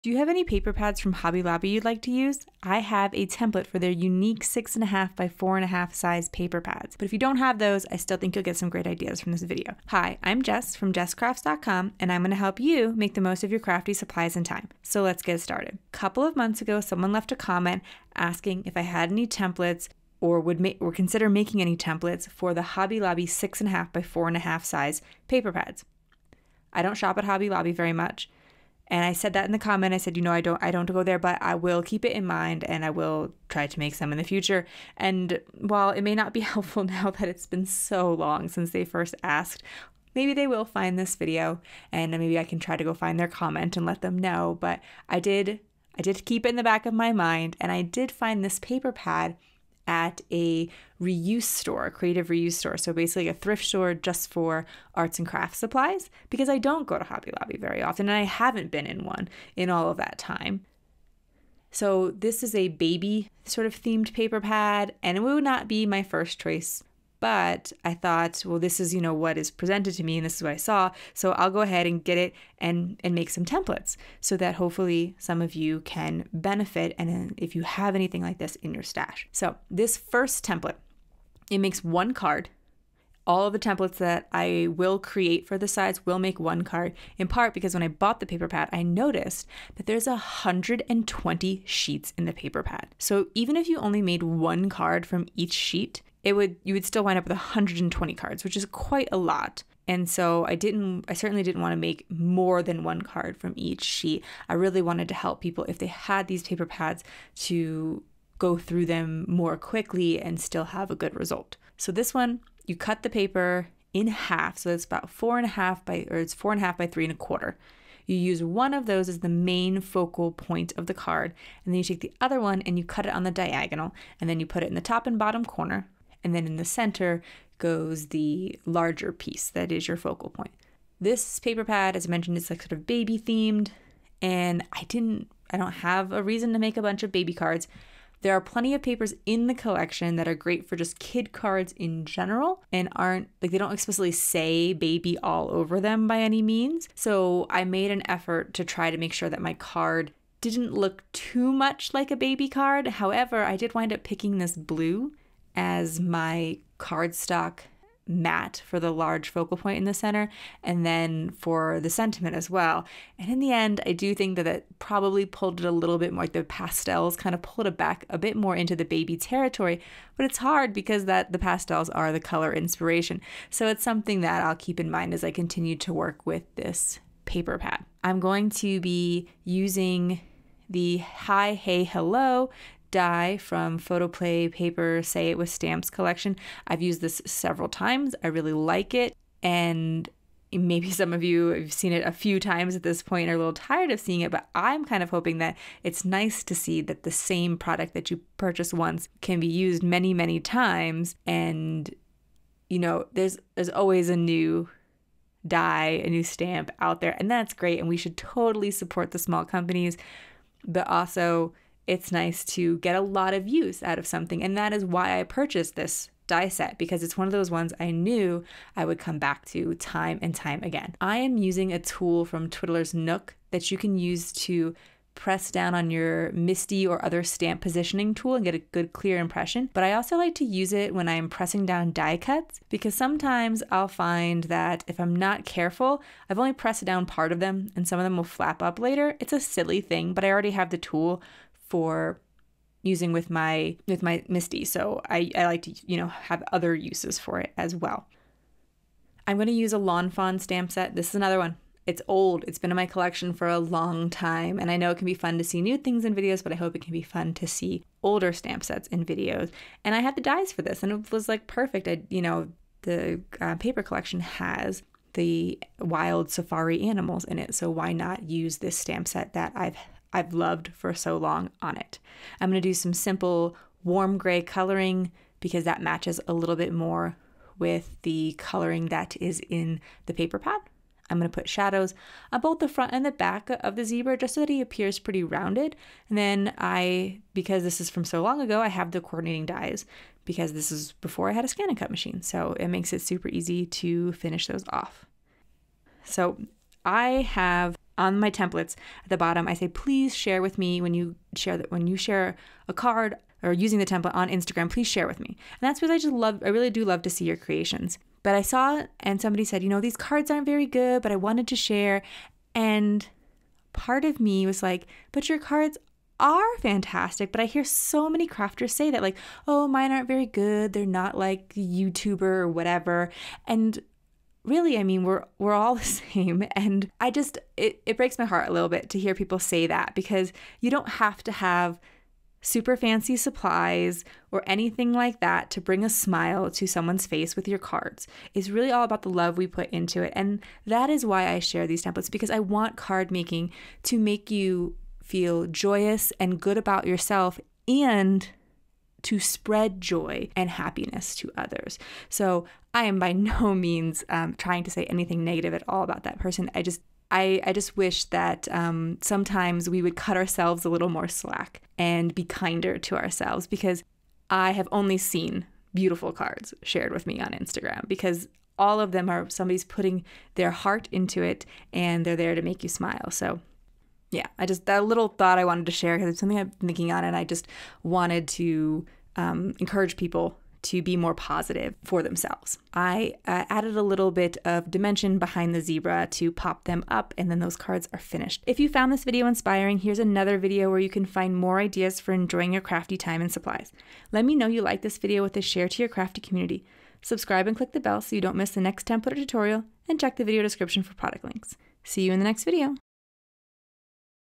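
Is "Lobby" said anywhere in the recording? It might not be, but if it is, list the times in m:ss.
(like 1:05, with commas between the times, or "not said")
0:01, 0:22, 0:27, 0:57.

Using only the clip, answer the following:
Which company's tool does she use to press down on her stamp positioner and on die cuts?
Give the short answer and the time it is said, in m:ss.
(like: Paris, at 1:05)
Twiddler's Nook, at 3:42.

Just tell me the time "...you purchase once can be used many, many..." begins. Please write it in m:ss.
3:18.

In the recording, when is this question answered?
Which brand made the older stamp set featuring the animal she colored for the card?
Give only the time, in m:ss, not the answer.
4:09.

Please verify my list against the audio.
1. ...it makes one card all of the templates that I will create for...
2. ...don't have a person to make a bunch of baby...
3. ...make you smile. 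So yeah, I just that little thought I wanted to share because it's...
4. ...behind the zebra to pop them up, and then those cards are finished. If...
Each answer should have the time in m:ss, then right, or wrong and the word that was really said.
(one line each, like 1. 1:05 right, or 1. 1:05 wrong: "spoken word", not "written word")
1. 1:21 right
2. 2:15 wrong: "reason", not "person"
3. 6:12 right
4. 6:25 right.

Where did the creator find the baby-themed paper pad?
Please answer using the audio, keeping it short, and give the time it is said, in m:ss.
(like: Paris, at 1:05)
A creative reuse store, at 0:51.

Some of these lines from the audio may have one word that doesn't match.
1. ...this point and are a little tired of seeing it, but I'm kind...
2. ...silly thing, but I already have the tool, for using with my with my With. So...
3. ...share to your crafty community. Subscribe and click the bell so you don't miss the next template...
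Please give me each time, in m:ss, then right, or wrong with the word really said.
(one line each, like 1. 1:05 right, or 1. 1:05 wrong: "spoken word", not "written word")
1. 3:12 right
2. 3:59 wrong: "MISTI", not "With"
3. 6:35 right.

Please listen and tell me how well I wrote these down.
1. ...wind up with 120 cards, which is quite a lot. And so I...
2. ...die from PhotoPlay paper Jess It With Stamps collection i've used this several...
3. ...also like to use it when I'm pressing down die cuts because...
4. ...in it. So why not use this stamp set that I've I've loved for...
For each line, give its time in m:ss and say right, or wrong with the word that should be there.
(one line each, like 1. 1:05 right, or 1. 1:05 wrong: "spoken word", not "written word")
1. 1:37 right
2. 3:02 wrong: "Say", not "Jess"
3. 3:49 right
4. 4:27 right.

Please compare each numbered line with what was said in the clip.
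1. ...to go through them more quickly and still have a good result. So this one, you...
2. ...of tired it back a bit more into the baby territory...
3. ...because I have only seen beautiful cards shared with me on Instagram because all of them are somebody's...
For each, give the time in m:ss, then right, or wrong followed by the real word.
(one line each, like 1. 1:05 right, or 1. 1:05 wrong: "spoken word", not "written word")
1. 1:47 right
2. 2:47 wrong: "pulled", not "tired"
3. 6:03 right.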